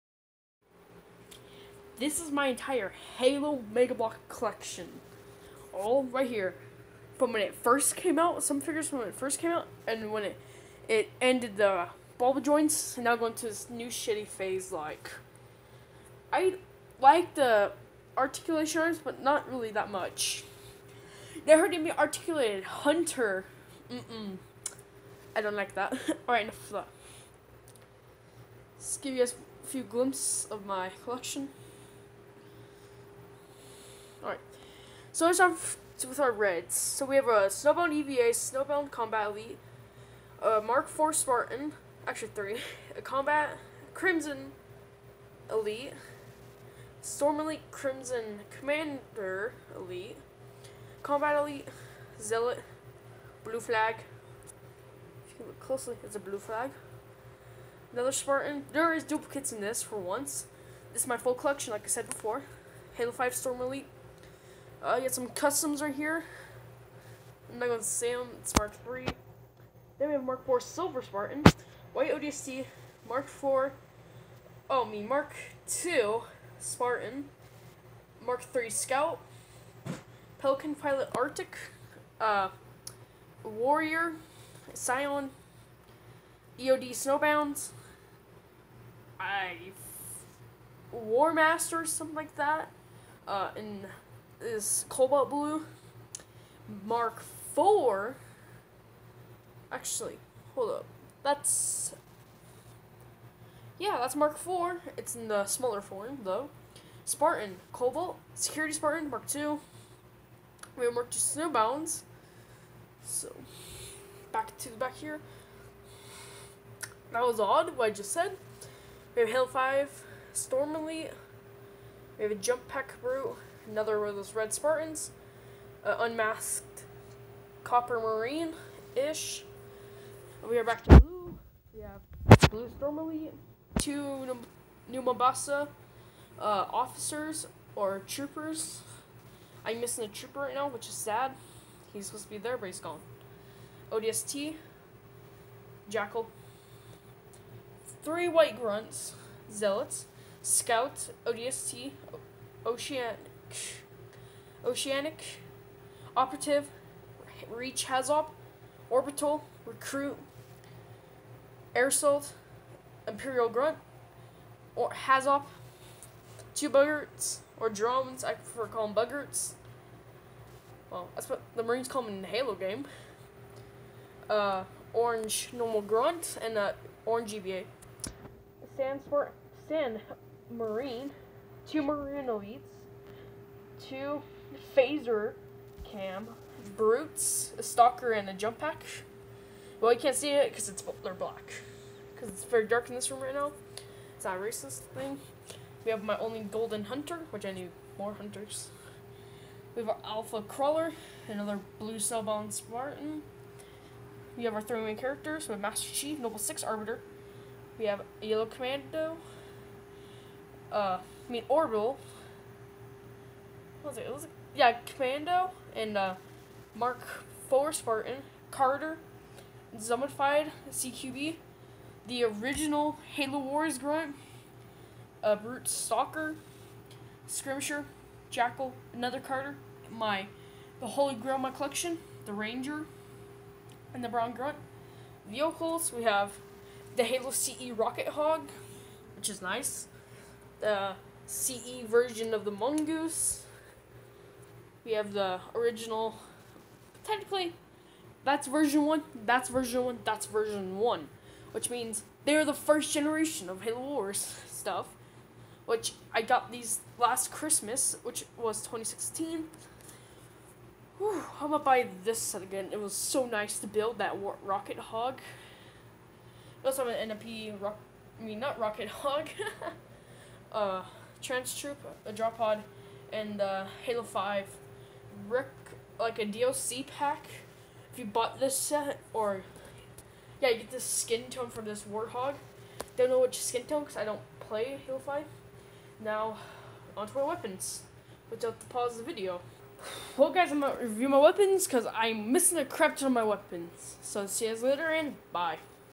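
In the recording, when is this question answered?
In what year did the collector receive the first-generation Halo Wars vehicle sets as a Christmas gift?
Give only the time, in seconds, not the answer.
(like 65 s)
258 s.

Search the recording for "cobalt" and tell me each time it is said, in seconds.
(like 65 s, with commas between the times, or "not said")
94 s, 107 s.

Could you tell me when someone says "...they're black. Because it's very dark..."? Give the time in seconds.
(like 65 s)
191 s.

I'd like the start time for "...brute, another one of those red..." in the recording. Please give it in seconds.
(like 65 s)
123 s.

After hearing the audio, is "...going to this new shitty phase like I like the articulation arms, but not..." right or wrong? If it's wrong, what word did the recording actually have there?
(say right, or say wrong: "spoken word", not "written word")
right.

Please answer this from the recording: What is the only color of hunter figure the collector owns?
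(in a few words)
golden.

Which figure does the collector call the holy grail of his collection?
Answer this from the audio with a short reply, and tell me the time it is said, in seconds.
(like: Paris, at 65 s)
The Ranger, at 232 s.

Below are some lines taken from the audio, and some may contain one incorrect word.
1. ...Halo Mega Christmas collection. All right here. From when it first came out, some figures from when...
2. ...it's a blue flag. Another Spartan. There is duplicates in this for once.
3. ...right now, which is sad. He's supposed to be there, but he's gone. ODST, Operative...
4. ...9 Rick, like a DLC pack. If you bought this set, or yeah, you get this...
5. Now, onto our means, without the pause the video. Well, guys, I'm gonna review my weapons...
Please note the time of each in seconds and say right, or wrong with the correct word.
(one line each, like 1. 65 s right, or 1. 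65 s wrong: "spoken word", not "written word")
1. 3 s wrong: "Bloks", not "Christmas"
2. 56 s right
3. 140 s wrong: "Jackal", not "Operative"
4. 274 s wrong: "5", not "9"
5. 286 s wrong: "weapons", not "means".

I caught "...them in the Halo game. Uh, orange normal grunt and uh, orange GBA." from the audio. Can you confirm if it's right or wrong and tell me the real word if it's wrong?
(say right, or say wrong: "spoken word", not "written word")
right.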